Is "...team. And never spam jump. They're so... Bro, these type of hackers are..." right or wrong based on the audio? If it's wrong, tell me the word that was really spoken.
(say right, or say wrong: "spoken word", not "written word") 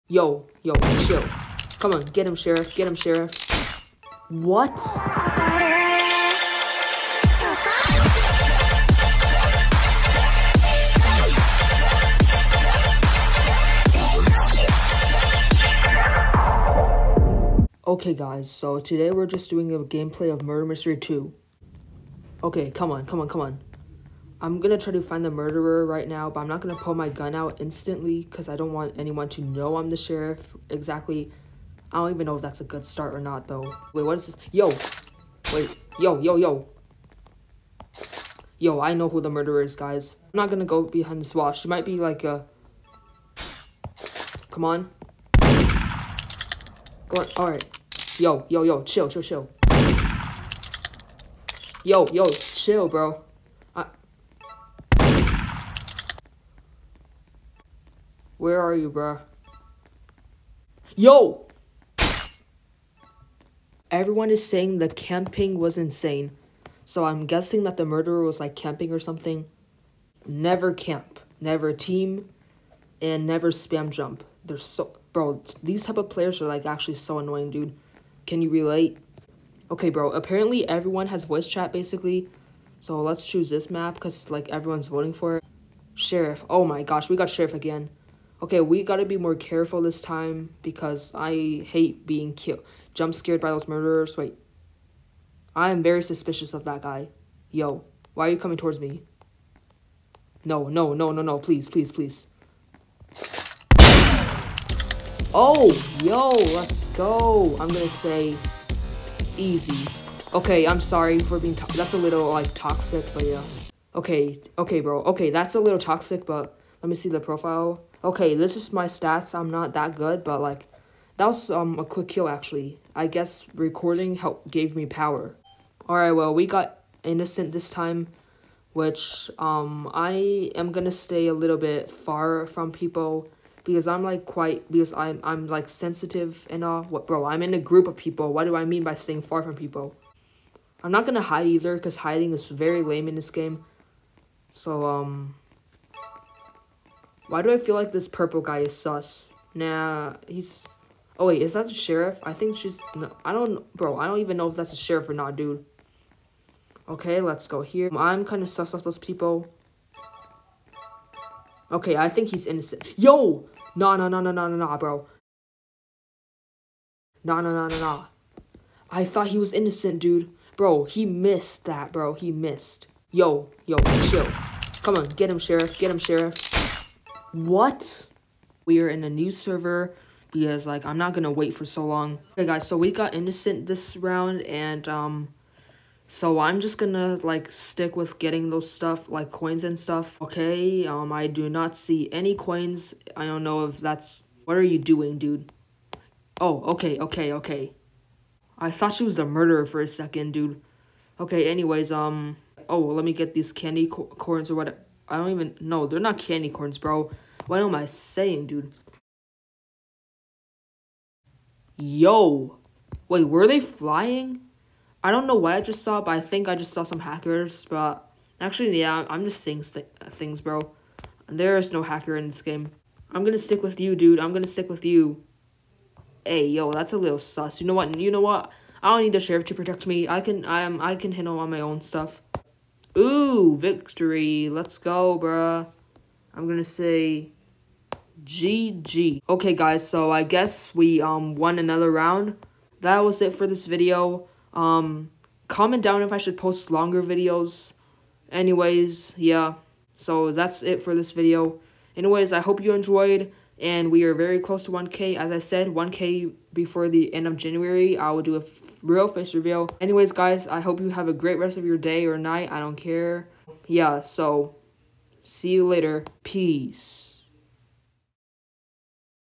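wrong: "players", not "hackers".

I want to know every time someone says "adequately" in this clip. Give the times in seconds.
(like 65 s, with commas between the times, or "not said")
not said.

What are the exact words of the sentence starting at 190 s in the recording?
Okay, um I do not see any coins.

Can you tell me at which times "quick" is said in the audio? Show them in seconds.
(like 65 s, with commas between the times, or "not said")
121 s.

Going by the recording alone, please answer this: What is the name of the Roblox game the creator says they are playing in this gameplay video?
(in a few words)
Murder Mystery 2.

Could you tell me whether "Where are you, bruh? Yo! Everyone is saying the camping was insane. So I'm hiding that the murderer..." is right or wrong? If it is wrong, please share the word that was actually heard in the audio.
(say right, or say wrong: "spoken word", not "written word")
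wrong: "guessing", not "hiding".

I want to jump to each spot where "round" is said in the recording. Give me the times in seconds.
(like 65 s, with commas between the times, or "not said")
183 s, 241 s.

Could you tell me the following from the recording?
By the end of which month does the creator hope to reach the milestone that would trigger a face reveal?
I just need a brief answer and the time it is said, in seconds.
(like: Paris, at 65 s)
January, at 257 s.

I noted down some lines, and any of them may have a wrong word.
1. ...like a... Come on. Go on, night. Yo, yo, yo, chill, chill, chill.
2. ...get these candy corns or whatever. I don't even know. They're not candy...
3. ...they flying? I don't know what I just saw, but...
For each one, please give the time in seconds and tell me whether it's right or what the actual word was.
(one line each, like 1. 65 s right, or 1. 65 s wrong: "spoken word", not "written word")
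1. 41 s wrong: "alright", not "night"
2. 203 s right
3. 213 s right.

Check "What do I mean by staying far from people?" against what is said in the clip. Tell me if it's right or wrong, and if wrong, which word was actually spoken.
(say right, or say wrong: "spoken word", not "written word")
right.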